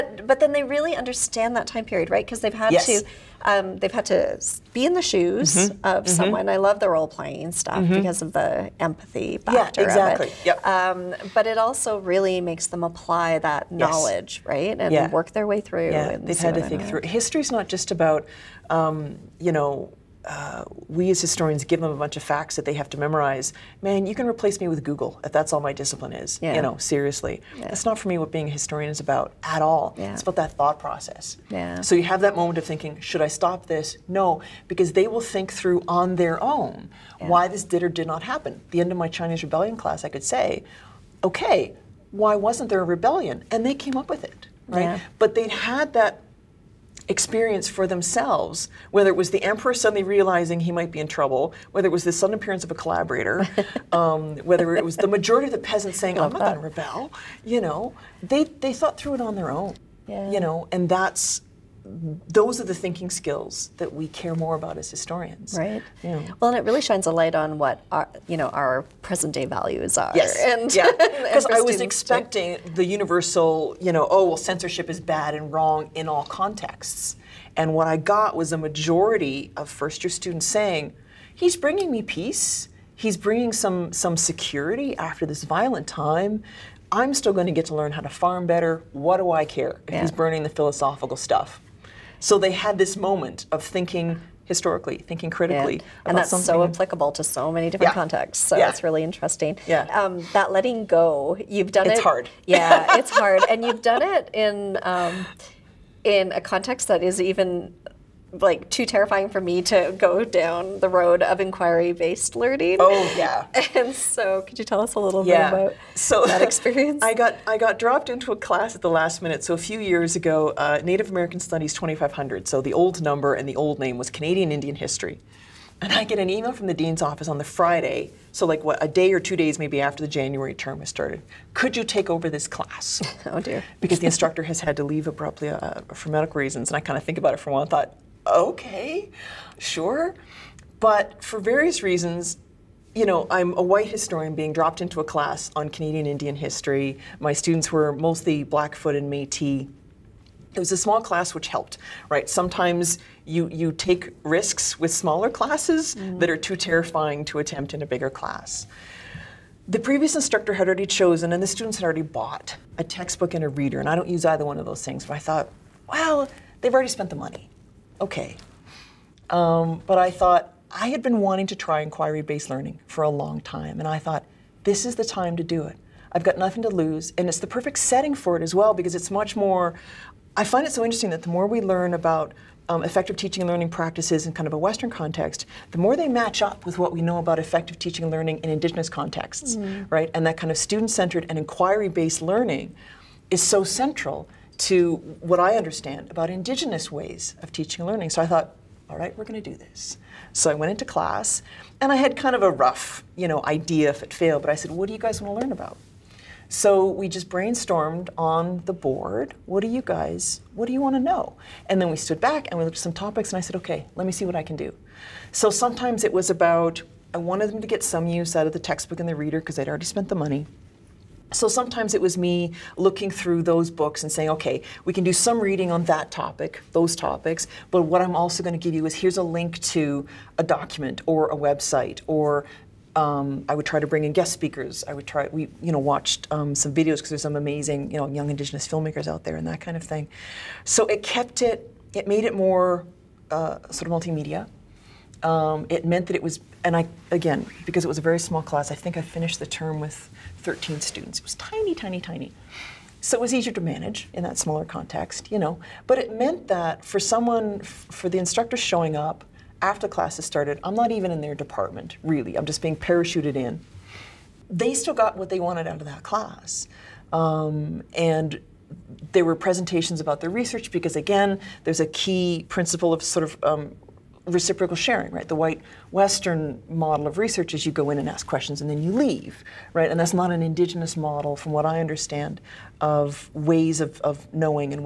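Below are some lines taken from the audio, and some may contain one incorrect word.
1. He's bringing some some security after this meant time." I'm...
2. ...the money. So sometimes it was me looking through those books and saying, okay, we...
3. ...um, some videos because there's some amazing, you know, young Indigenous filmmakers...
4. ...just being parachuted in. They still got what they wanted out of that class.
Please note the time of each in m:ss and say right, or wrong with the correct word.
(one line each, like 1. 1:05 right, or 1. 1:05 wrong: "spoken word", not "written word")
1. 1:22 wrong: "violent", not "meant"
2. 3:40 right
3. 3:56 right
4. 4:22 right.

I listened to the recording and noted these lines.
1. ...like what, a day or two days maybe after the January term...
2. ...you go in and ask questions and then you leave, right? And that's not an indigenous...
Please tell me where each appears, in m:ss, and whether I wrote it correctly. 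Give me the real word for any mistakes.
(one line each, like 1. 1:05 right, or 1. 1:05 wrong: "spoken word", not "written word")
1. 2:08 right
2. 4:37 right.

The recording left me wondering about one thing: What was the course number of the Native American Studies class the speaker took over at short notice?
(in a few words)
2500.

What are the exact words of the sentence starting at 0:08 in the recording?
because of the empathy factor yeah, exactly.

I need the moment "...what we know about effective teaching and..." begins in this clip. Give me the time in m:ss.
3:06.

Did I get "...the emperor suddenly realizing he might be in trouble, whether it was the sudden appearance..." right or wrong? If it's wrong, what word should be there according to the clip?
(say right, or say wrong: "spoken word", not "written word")
right.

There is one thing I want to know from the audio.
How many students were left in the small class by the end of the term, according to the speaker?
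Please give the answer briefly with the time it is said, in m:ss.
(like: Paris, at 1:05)
13, at 4:10.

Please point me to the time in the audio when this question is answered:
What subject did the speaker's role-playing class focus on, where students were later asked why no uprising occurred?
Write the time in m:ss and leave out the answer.
0:39.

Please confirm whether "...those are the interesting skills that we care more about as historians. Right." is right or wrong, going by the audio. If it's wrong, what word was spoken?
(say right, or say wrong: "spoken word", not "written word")
wrong: "thinking", not "interesting".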